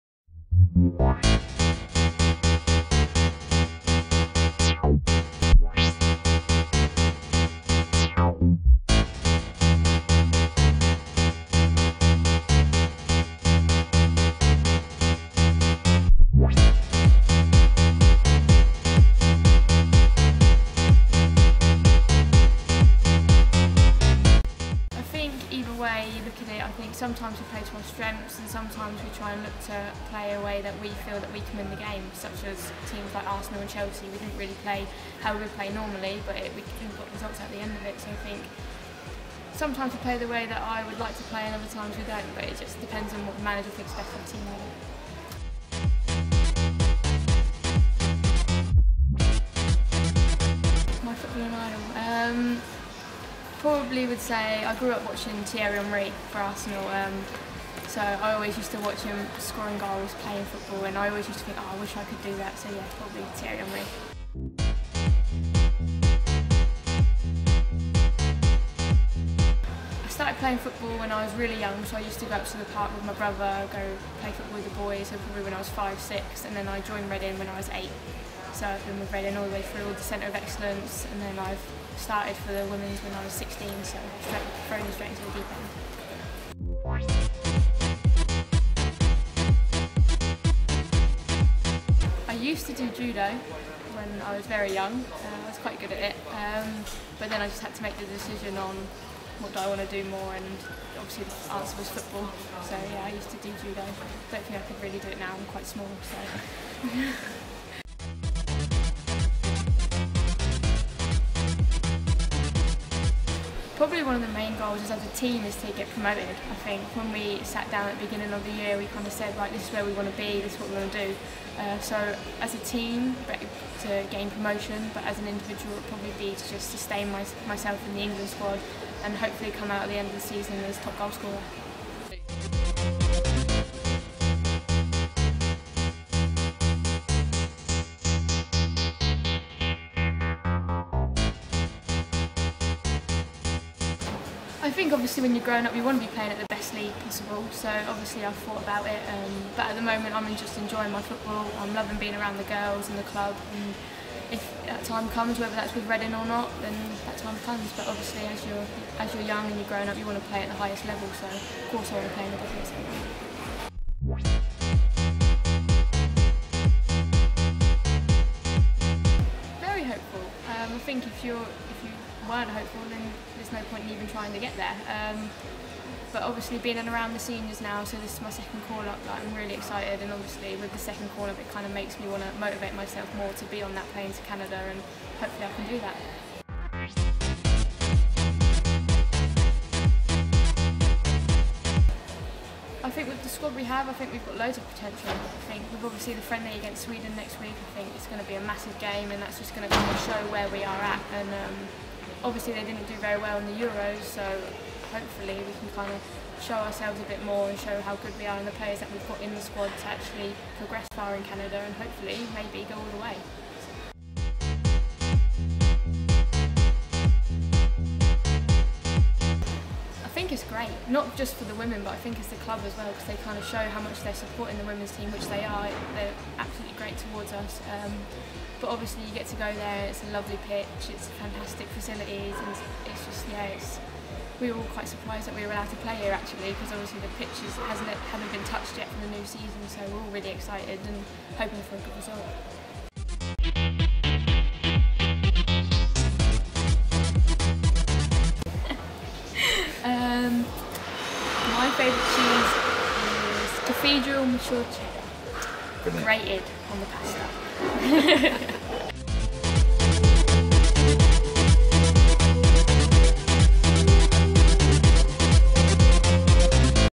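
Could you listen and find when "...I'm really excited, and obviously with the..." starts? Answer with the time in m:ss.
2:59.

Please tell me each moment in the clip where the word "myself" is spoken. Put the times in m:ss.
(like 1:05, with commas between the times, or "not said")
2:07, 3:02.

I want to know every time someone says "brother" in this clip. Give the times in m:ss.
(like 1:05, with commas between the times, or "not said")
1:13.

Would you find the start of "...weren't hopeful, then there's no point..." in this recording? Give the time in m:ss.
2:52.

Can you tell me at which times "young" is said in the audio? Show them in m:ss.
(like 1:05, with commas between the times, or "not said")
1:11, 1:34, 2:39.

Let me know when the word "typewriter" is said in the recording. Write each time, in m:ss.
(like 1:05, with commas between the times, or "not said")
not said.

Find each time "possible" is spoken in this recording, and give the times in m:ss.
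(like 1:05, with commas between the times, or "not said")
2:26.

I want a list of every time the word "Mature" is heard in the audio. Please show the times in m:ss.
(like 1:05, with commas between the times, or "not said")
4:14.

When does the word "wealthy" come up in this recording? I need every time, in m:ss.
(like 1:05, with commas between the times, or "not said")
not said.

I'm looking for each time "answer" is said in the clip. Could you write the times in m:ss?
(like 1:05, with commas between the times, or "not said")
1:41.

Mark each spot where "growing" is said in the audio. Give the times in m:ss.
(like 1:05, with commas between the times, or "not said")
2:25, 2:39.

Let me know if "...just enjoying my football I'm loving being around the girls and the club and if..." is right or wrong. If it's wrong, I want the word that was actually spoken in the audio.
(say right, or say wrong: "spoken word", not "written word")
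right.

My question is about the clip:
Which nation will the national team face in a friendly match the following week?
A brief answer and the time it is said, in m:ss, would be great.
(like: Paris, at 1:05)
Sweden, at 3:16.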